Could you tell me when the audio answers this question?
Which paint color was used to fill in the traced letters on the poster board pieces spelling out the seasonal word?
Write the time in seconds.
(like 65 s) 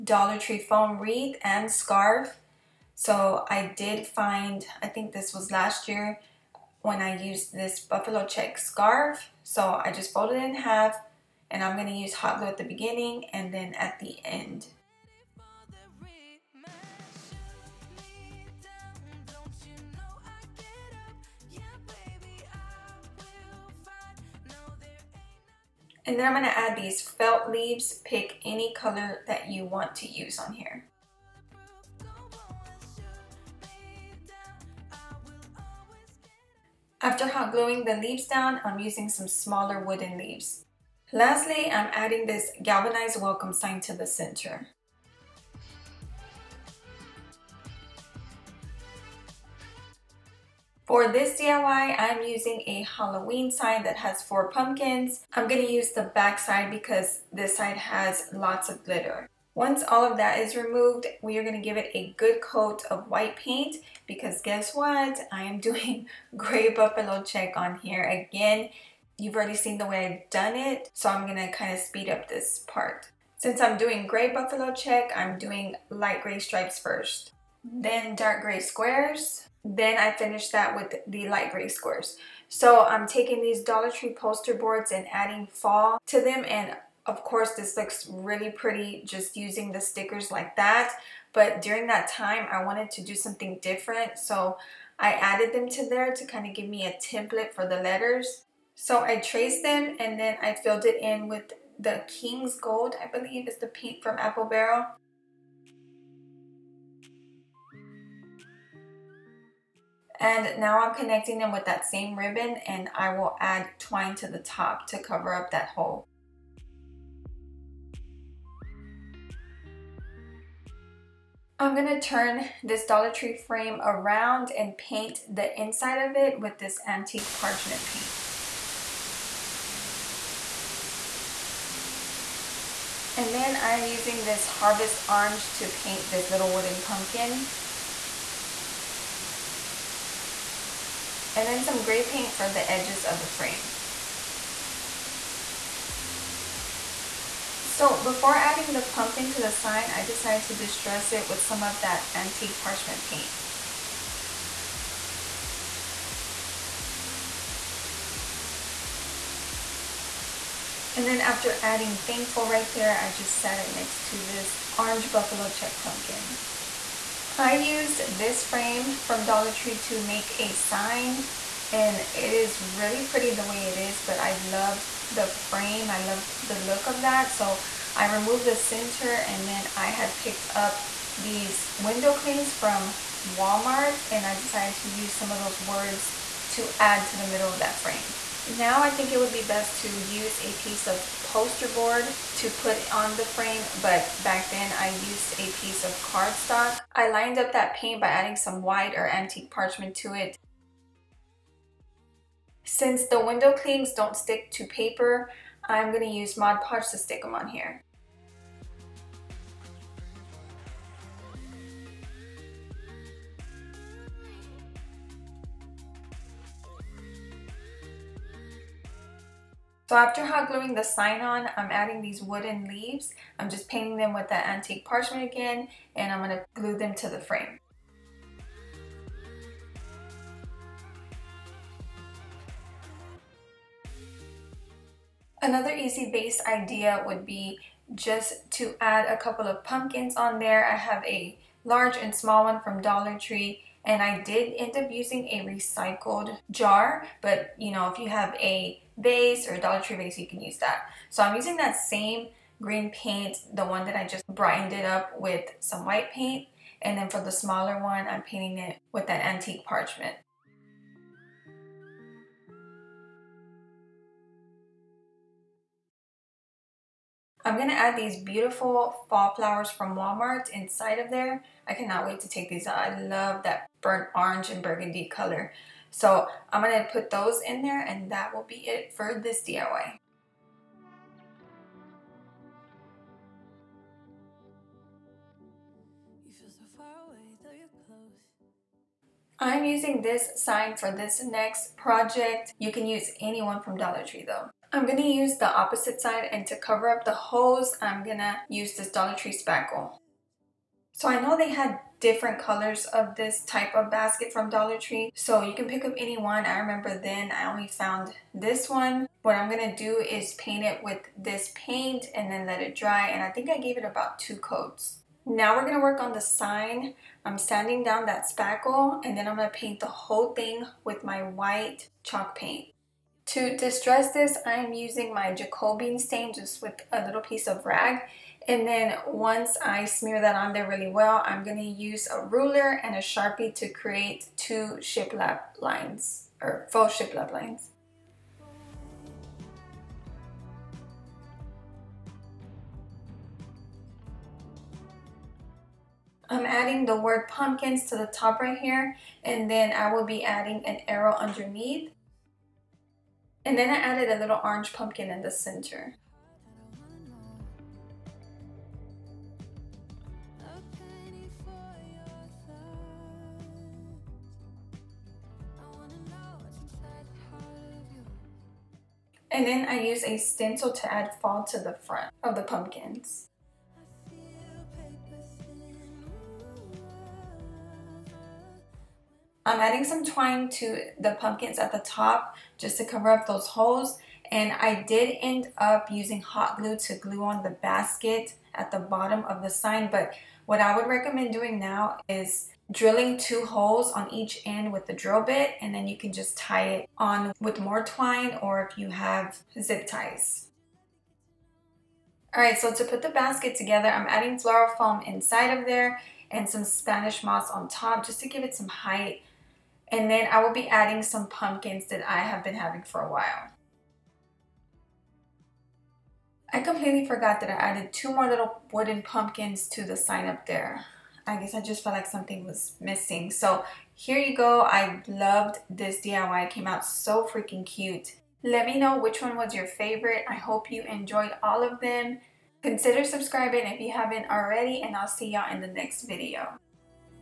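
102 s.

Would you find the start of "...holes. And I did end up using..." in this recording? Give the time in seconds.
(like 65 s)
383 s.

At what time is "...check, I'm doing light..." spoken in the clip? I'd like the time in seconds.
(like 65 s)
74 s.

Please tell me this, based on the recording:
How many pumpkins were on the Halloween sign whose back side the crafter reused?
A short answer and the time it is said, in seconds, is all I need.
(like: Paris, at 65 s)
4, at 54 s.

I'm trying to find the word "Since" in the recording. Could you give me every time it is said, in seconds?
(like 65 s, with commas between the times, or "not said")
73 s, 202 s.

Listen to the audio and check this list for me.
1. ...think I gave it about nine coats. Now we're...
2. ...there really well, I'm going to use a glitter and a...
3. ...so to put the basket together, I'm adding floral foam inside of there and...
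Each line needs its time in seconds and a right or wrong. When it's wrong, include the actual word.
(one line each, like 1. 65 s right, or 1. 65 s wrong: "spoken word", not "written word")
1. 313 s wrong: "two", not "nine"
2. 330 s wrong: "ruler", not "glitter"
3. 402 s right.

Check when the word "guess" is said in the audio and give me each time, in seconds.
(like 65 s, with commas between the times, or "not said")
64 s, 421 s.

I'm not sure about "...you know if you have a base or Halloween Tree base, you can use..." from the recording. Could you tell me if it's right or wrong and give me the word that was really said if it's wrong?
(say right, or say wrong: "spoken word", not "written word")
wrong: "Dollar", not "Halloween".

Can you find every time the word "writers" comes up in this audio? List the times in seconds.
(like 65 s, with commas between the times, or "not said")
not said.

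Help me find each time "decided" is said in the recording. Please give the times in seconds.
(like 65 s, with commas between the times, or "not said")
150 s, 184 s.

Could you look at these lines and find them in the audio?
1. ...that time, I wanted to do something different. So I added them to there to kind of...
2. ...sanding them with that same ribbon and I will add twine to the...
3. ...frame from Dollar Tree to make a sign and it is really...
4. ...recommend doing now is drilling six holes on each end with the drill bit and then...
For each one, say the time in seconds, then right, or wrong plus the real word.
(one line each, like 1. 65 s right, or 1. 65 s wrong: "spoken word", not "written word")
1. 91 s right
2. 110 s wrong: "connecting", not "sanding"
3. 168 s right
4. 390 s wrong: "two", not "six".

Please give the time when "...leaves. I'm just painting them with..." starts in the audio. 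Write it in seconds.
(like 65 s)
222 s.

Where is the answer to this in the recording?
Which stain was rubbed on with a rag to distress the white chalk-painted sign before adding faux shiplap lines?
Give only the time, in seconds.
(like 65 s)
325 s.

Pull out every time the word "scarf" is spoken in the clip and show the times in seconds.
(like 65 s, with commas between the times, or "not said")
1 s, 8 s.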